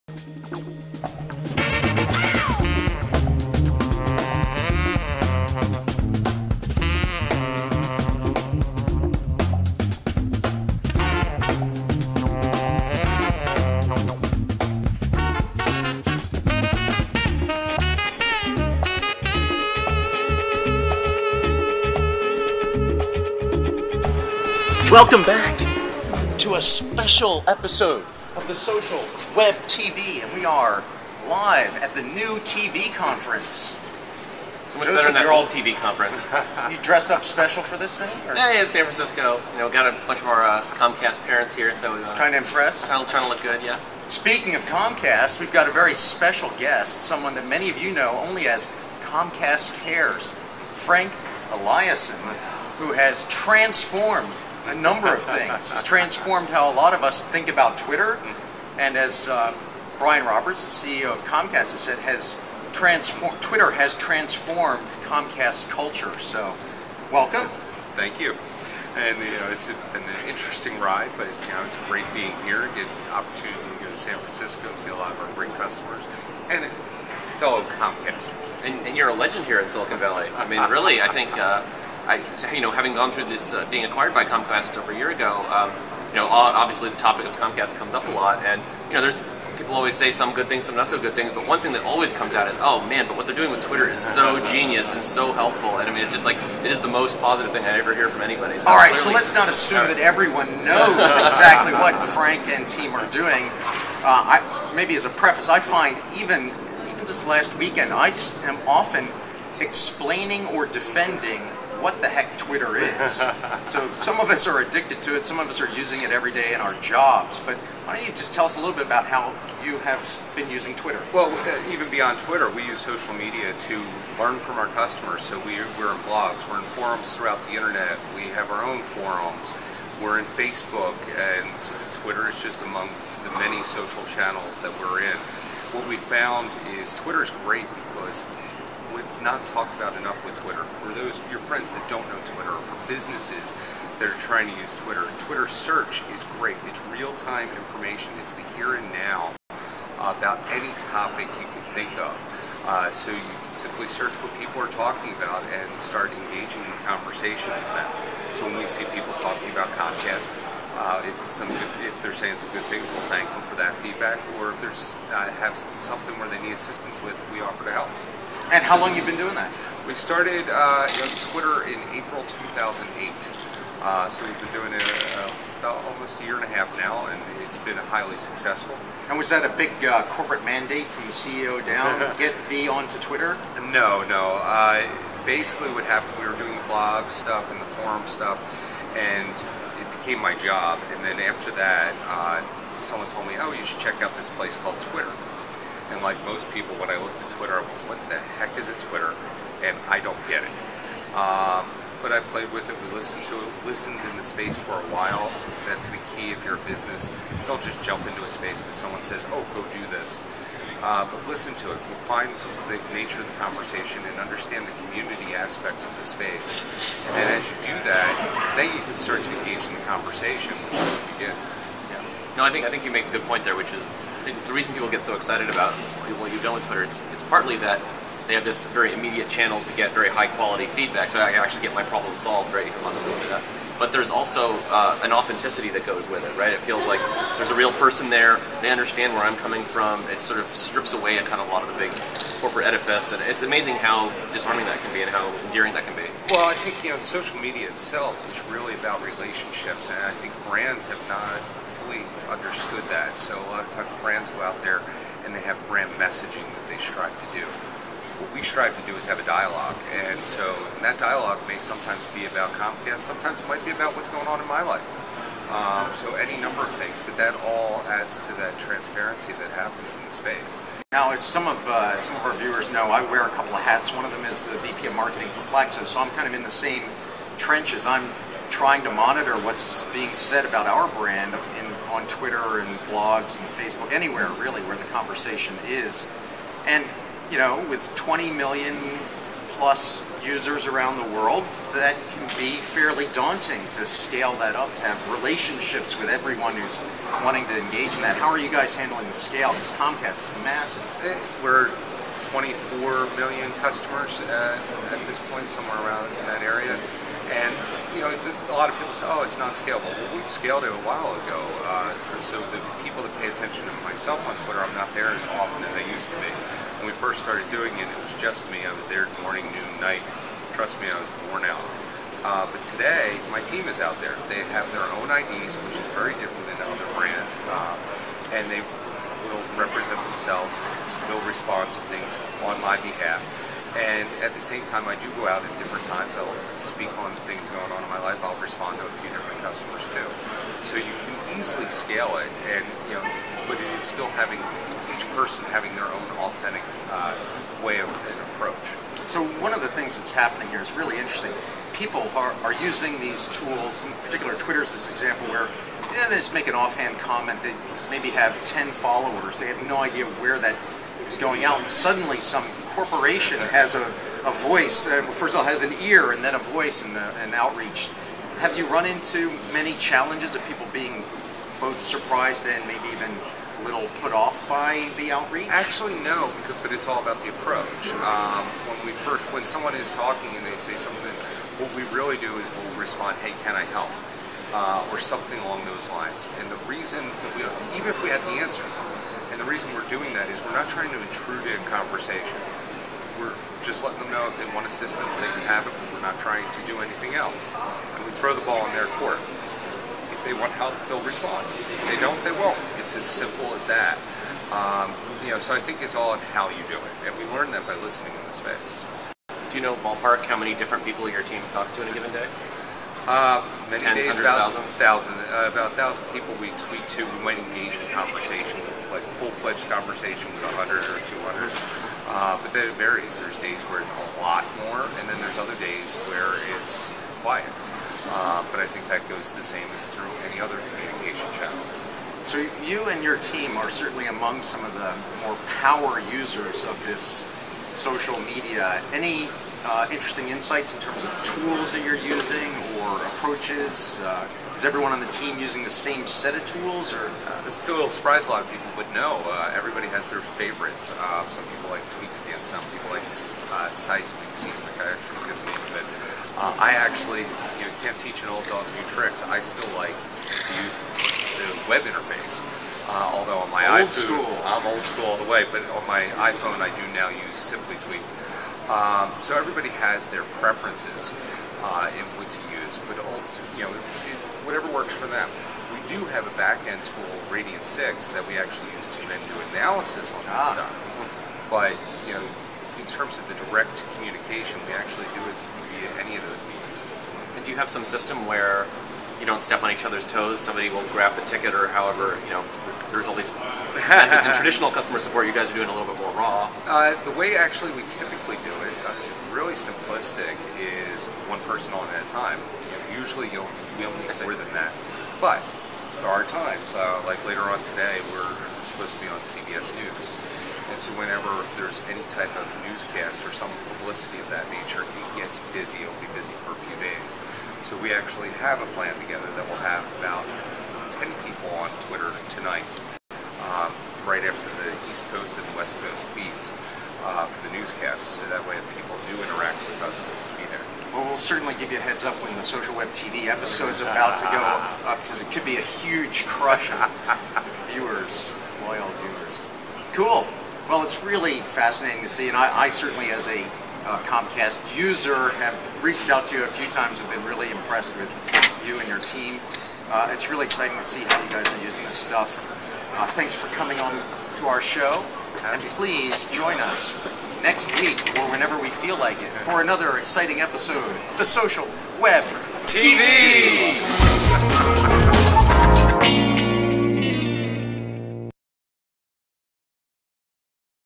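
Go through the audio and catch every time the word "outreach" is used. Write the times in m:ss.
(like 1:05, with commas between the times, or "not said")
6:07, 6:15.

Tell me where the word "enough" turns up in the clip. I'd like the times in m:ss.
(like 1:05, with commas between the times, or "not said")
2:19.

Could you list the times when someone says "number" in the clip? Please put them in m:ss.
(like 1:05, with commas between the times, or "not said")
0:54, 4:26.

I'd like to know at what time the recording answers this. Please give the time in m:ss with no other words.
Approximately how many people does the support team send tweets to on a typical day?
6:55.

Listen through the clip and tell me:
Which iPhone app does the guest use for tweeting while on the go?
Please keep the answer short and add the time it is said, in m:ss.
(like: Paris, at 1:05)
Simply Tweet, at 7:47.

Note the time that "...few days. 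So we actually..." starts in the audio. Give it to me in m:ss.
8:36.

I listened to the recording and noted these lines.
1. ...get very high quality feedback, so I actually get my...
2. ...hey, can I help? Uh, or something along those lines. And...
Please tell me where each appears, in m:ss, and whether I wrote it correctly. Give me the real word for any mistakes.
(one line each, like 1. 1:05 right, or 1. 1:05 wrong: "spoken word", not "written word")
1. 3:49 right
2. 6:23 right.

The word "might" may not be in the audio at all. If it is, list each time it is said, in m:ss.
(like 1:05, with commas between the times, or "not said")
4:23, 6:57.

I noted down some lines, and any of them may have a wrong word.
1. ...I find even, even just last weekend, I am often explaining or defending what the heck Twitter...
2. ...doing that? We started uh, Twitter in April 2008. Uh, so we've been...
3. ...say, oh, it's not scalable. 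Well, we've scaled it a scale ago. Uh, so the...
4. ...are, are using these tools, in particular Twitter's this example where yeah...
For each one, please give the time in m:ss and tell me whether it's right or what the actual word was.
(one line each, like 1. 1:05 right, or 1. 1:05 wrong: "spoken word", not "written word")
1. 1:45 right
2. 2:49 right
3. 5:08 wrong: "while", not "scale"
4. 5:52 right.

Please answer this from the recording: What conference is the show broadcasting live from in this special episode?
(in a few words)
NewTeeVee.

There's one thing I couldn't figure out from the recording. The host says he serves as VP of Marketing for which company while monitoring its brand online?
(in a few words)
Plaxo.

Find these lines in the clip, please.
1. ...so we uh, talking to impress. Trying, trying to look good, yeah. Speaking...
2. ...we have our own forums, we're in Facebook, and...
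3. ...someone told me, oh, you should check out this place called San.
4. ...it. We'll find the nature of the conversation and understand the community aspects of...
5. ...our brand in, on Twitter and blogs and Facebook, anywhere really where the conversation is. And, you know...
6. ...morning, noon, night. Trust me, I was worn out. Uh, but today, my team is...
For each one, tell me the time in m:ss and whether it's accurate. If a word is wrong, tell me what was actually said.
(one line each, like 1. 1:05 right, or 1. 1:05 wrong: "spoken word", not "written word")
1. 0:41 wrong: "trying", not "talking"
2. 2:08 right
3. 3:12 wrong: "Twitter", not "San"
4. 3:31 right
5. 4:40 right
6. 5:19 right.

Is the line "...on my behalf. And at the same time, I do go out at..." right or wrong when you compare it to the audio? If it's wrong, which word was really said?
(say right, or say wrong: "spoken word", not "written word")
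right.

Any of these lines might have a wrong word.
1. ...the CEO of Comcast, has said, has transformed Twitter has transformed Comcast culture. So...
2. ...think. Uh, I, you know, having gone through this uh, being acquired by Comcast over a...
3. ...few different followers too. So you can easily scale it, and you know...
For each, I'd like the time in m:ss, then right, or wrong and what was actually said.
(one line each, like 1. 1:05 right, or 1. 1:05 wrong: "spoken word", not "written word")
1. 1:00 right
2. 1:21 right
3. 5:38 wrong: "customers", not "followers".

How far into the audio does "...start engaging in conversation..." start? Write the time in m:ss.
2:35.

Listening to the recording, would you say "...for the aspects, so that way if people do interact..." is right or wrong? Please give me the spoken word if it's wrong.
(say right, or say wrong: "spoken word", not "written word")
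wrong: "newscasts", not "aspects".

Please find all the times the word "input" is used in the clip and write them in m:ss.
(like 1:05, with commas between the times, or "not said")
7:51.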